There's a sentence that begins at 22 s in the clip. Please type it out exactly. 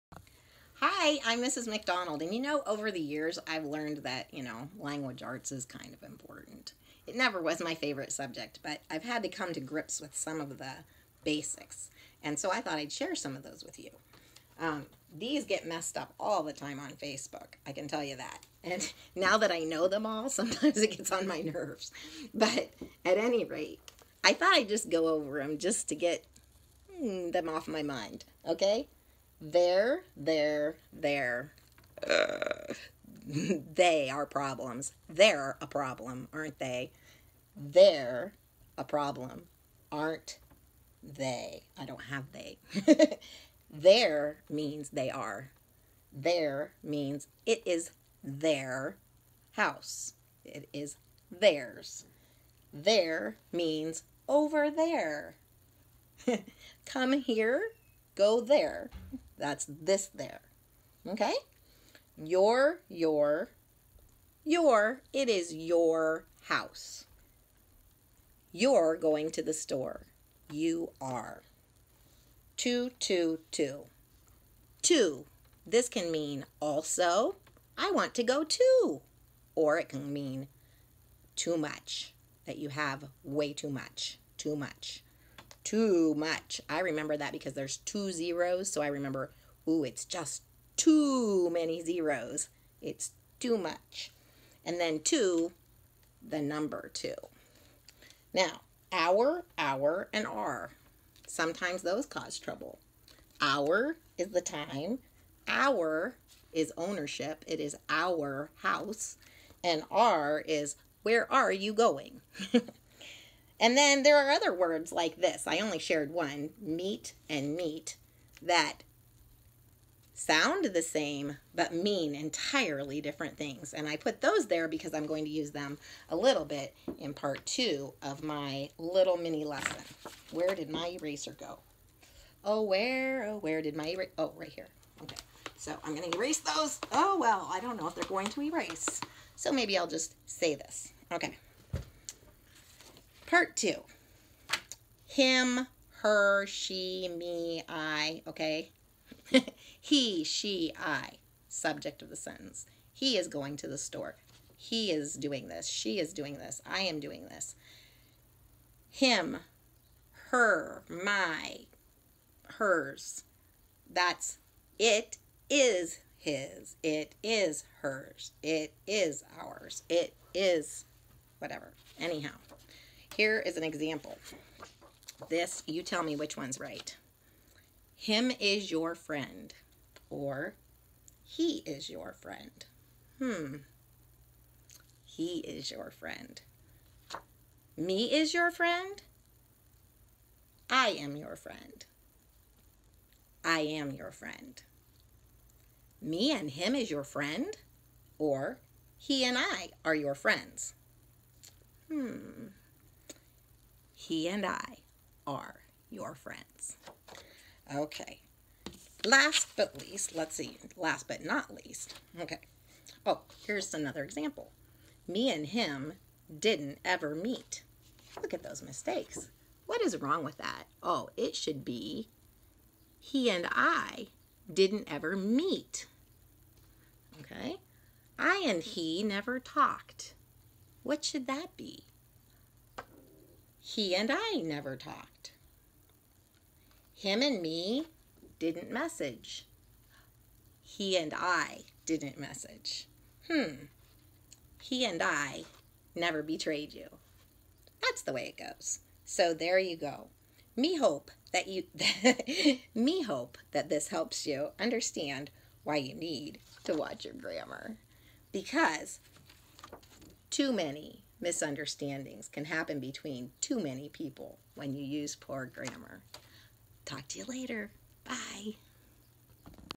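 But at any rate, I thought I'd just go over them just to get hmm, them off my mind.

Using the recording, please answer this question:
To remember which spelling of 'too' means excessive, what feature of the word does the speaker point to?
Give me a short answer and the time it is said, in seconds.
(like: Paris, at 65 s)
two zeros, at 87 s.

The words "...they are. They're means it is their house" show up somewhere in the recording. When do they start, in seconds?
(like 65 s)
44 s.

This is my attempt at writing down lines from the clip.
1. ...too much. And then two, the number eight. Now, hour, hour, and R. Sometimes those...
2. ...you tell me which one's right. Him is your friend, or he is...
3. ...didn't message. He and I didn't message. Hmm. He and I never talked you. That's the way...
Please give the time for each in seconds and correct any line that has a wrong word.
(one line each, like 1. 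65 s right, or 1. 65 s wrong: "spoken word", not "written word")
1. 93 s wrong: "two", not "eight"
2. 175 s right
3. 238 s wrong: "betrayed", not "talked".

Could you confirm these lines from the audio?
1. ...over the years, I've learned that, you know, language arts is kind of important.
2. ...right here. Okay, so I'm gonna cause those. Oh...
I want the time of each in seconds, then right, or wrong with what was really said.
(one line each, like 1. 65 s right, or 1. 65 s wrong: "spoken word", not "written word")
1. 2 s right
2. 134 s wrong: "erase", not "cause".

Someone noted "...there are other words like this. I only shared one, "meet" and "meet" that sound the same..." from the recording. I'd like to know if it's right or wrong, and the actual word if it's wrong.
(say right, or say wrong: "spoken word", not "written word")
right.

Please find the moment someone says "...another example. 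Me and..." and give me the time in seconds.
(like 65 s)
213 s.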